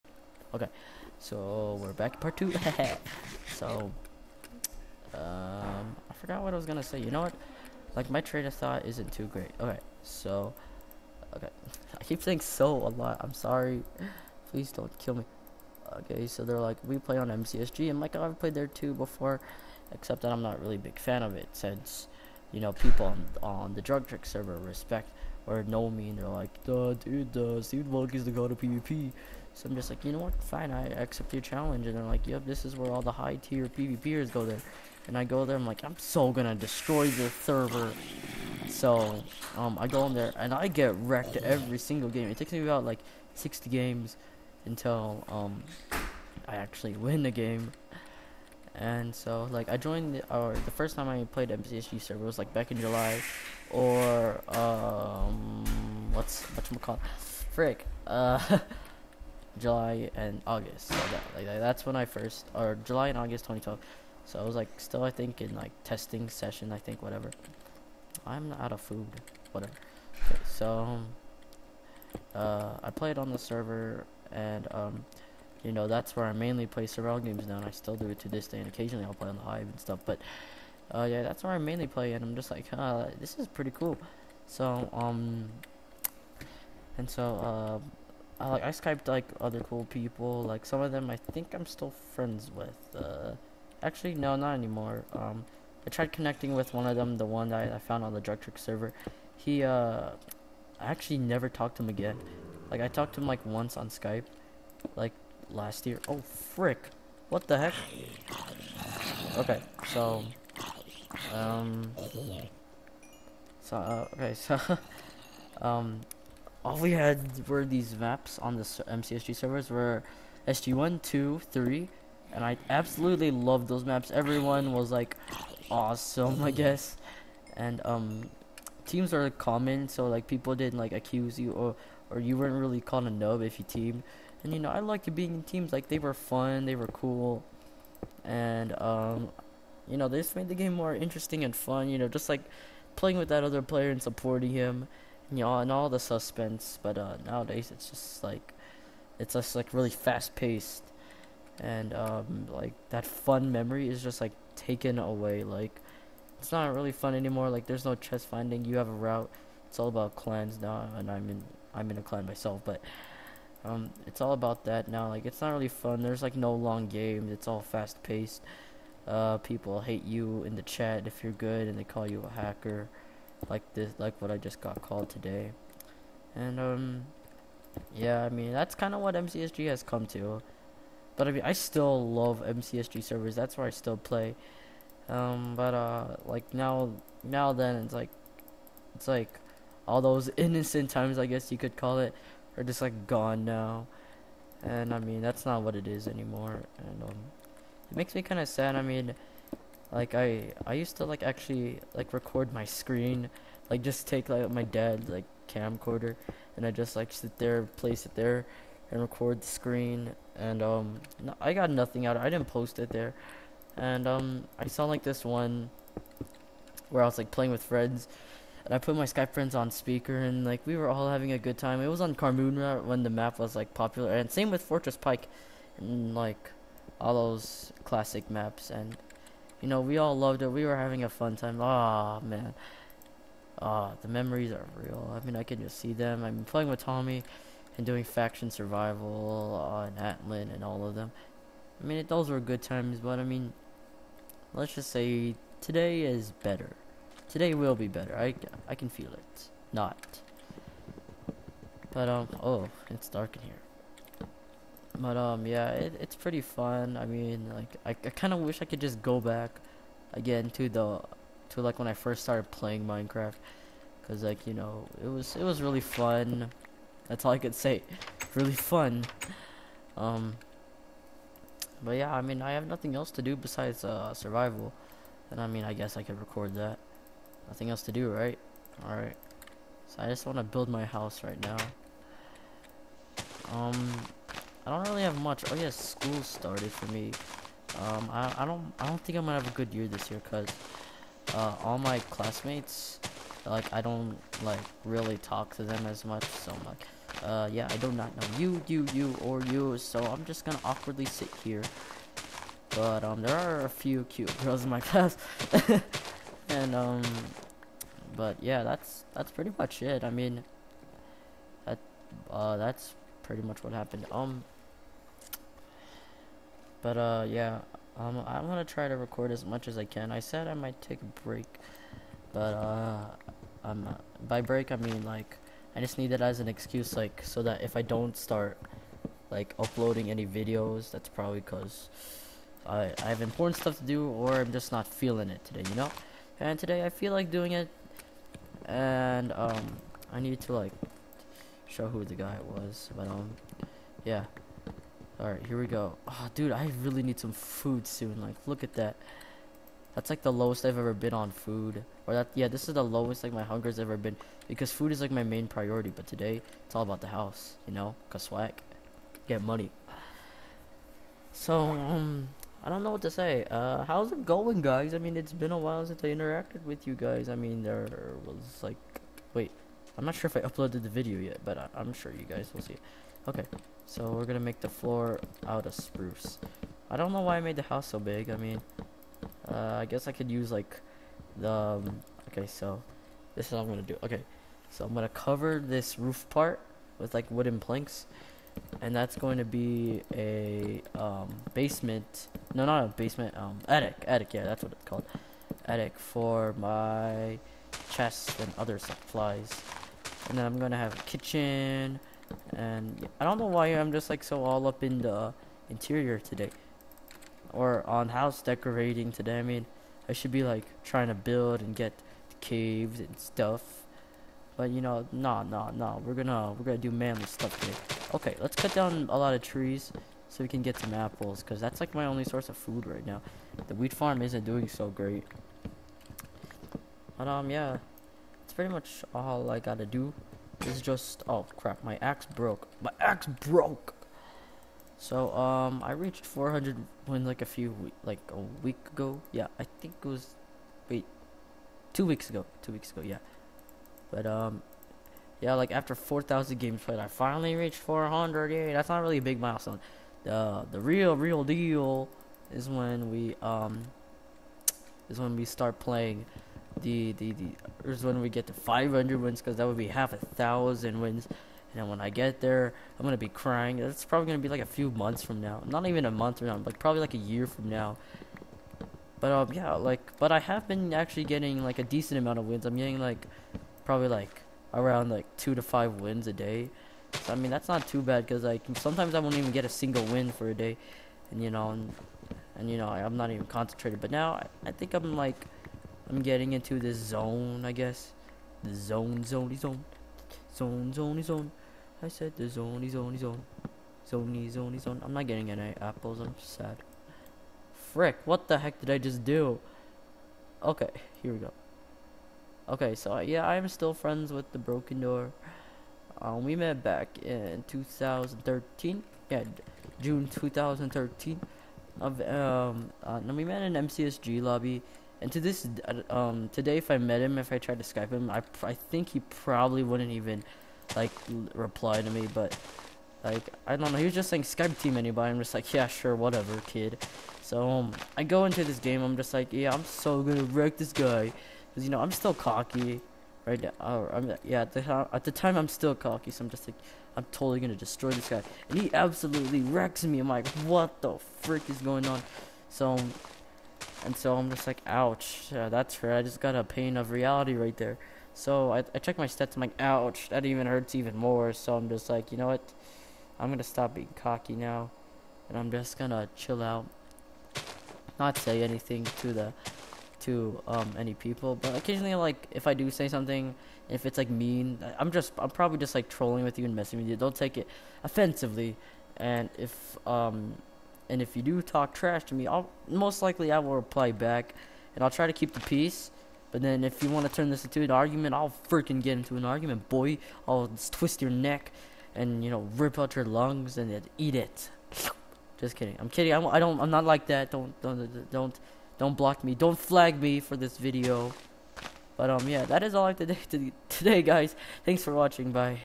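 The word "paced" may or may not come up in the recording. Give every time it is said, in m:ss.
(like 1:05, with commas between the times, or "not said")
2:30, 2:48.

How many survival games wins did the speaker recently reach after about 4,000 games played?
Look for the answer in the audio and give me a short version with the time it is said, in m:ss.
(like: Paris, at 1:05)
400, at 7:26.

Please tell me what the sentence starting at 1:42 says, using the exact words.
Like I talked to him like once on Skype, like last year.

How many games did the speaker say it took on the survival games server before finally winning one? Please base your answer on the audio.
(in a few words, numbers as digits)
60.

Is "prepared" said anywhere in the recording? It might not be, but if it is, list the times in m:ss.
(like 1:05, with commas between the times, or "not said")
not said.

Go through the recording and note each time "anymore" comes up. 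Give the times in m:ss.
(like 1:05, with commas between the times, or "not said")
1:34, 2:37, 3:16.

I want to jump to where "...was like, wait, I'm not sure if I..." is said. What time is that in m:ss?
6:08.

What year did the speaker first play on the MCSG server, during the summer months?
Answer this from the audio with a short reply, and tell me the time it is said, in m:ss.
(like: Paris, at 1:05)
2012, at 1:02.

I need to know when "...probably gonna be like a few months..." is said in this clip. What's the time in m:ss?
7:44.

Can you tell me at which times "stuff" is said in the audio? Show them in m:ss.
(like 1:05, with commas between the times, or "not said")
1:19, 5:33, 6:53, 6:57.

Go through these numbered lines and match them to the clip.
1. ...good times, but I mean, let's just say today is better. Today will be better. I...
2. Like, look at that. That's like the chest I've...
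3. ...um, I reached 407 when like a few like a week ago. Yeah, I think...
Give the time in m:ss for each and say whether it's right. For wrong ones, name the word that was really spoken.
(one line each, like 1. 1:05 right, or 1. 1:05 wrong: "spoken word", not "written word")
1. 4:02 right
2. 5:48 wrong: "lowest", not "chest"
3. 7:15 wrong: "400", not "407".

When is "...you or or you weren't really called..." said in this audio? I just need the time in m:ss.
2:11.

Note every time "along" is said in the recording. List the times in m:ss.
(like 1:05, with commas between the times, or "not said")
not said.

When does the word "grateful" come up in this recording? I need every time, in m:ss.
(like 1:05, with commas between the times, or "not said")
not said.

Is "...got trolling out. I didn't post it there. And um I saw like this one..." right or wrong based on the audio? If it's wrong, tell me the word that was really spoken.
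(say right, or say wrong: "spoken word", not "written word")
wrong: "nothing", not "trolling".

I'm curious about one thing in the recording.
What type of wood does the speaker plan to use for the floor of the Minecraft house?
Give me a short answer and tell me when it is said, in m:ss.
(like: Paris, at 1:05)
spruce, at 6:15.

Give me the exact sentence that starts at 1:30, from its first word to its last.
Like some of them, I think I'm still friends with.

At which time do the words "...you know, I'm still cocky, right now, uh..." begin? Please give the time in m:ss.
8:51.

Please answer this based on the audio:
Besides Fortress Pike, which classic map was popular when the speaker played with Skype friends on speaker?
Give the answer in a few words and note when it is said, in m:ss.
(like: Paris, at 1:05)
Carmoonra, at 3:42.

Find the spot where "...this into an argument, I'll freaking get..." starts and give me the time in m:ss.
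9:37.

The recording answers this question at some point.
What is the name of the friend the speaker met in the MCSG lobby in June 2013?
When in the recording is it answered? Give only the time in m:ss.
8:24.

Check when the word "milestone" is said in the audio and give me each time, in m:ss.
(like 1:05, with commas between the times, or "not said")
7:29.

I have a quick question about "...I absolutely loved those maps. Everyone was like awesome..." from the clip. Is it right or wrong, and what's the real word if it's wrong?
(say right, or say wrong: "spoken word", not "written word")
right.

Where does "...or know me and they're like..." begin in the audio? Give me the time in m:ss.
0:25.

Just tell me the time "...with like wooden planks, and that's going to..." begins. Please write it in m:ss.
6:26.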